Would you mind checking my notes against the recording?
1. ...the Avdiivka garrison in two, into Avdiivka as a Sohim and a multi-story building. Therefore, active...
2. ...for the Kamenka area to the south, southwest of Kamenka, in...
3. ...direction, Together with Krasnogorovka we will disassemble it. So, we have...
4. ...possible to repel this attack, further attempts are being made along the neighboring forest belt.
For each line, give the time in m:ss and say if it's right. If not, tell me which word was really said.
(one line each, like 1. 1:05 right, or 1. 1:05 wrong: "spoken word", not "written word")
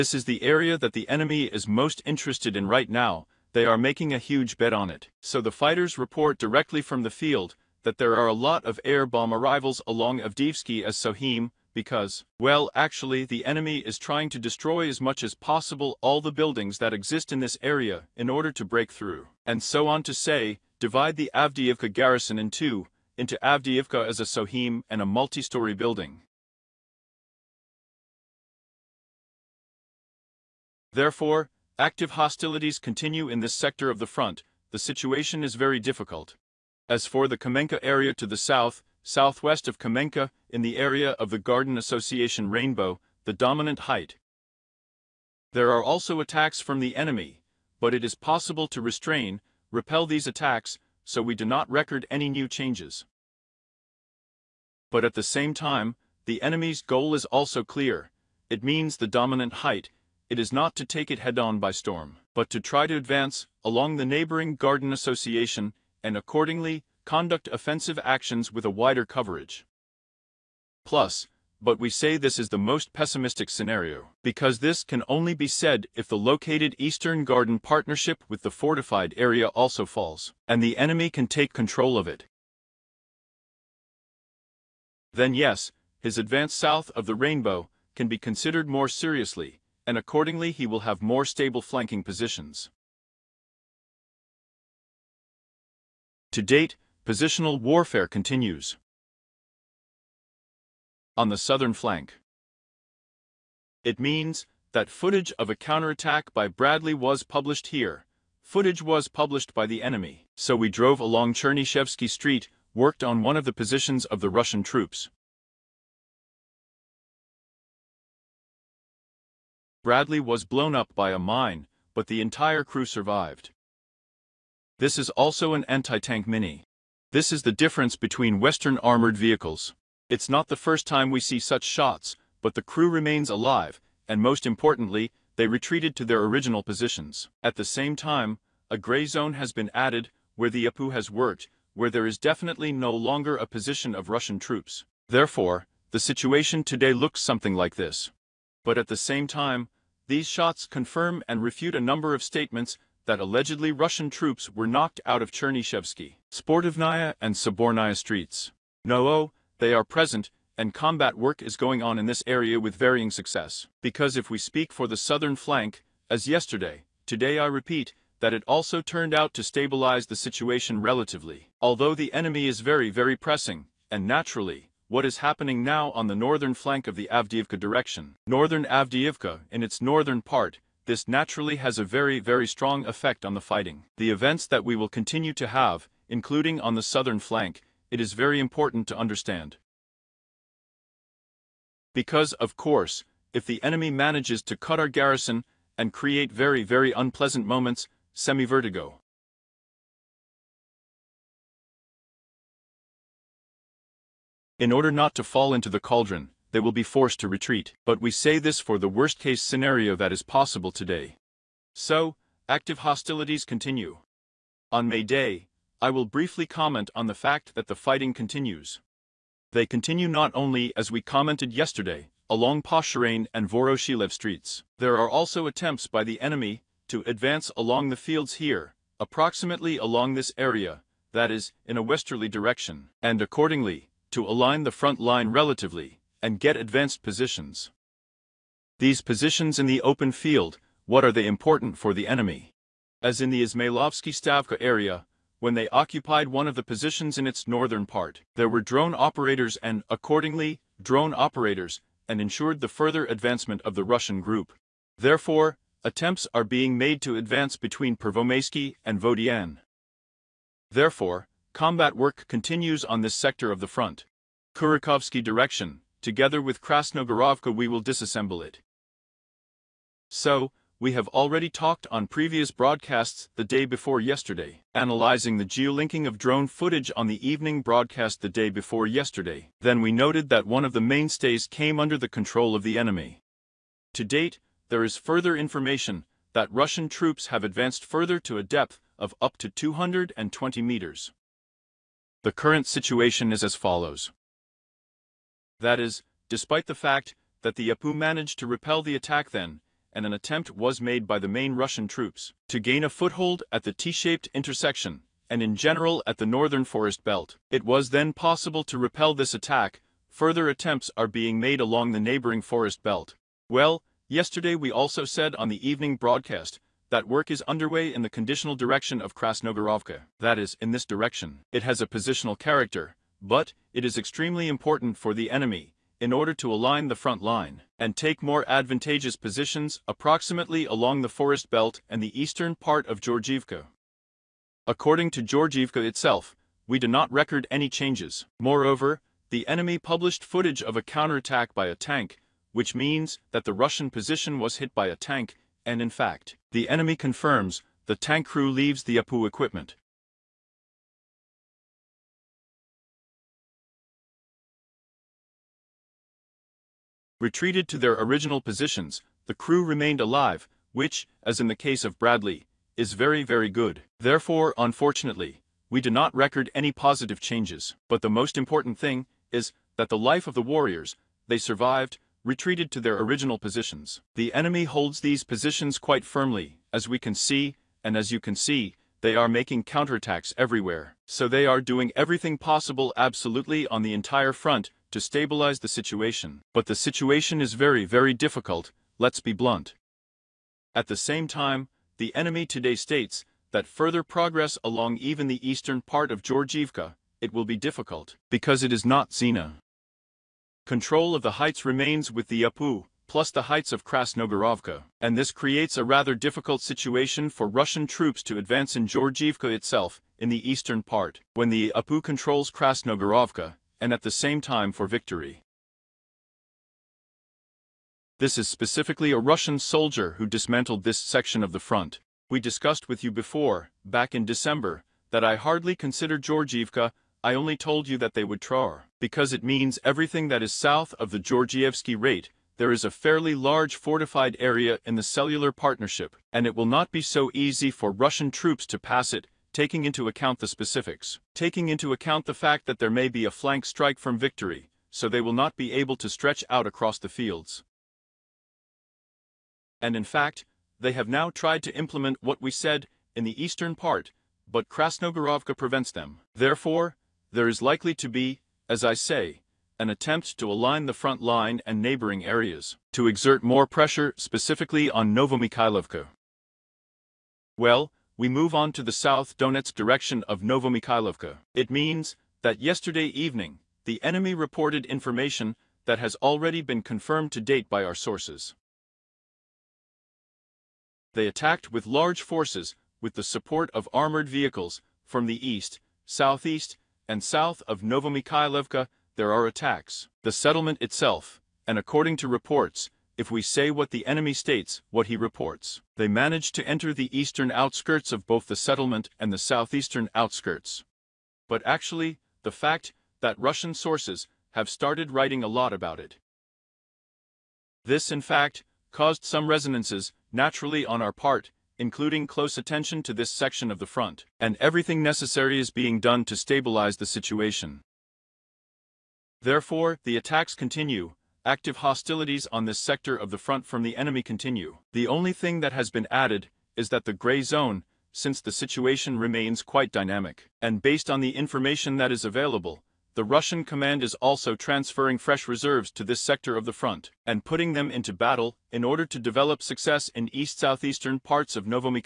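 1. 0:21 right
2. 0:37 right
3. 4:25 right
4. 5:08 right.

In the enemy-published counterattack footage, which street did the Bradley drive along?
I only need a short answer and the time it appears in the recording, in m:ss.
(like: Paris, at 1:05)
Chernyshevsky Street, at 1:51.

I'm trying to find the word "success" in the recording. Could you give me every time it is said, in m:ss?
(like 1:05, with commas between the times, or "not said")
2:43, 8:59.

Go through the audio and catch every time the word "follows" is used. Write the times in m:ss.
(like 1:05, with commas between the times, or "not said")
4:53.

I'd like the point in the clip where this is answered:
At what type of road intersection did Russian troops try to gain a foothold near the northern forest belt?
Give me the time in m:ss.
5:03.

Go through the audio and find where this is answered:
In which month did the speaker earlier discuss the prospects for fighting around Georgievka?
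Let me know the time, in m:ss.
7:04.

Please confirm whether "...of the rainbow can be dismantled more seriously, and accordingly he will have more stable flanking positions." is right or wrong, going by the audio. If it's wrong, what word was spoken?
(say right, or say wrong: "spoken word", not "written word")
wrong: "considered", not "dismantled".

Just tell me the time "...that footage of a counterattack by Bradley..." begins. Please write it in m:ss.
1:44.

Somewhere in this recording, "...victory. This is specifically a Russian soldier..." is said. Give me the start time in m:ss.
6:54.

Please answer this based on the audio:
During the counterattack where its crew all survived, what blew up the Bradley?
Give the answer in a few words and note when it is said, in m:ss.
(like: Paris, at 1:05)
A mine, at 2:01.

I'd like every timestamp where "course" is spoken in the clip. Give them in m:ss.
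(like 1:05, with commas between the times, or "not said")
3:12.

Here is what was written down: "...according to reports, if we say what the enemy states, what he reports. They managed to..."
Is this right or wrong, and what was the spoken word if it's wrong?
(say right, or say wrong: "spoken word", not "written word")
right.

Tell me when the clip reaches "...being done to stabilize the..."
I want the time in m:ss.
8:35.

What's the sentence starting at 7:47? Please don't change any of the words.
Well, we move on to the south Donetsk direction of Novomikhailovka.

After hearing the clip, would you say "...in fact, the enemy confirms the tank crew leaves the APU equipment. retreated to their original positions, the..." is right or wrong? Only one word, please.
right.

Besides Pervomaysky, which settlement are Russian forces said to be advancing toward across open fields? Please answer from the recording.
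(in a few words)
Vodiane.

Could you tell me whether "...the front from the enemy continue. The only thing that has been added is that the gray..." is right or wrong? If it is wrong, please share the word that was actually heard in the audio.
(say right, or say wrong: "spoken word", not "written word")
right.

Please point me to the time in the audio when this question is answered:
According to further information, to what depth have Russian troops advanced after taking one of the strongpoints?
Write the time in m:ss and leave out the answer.
4:49.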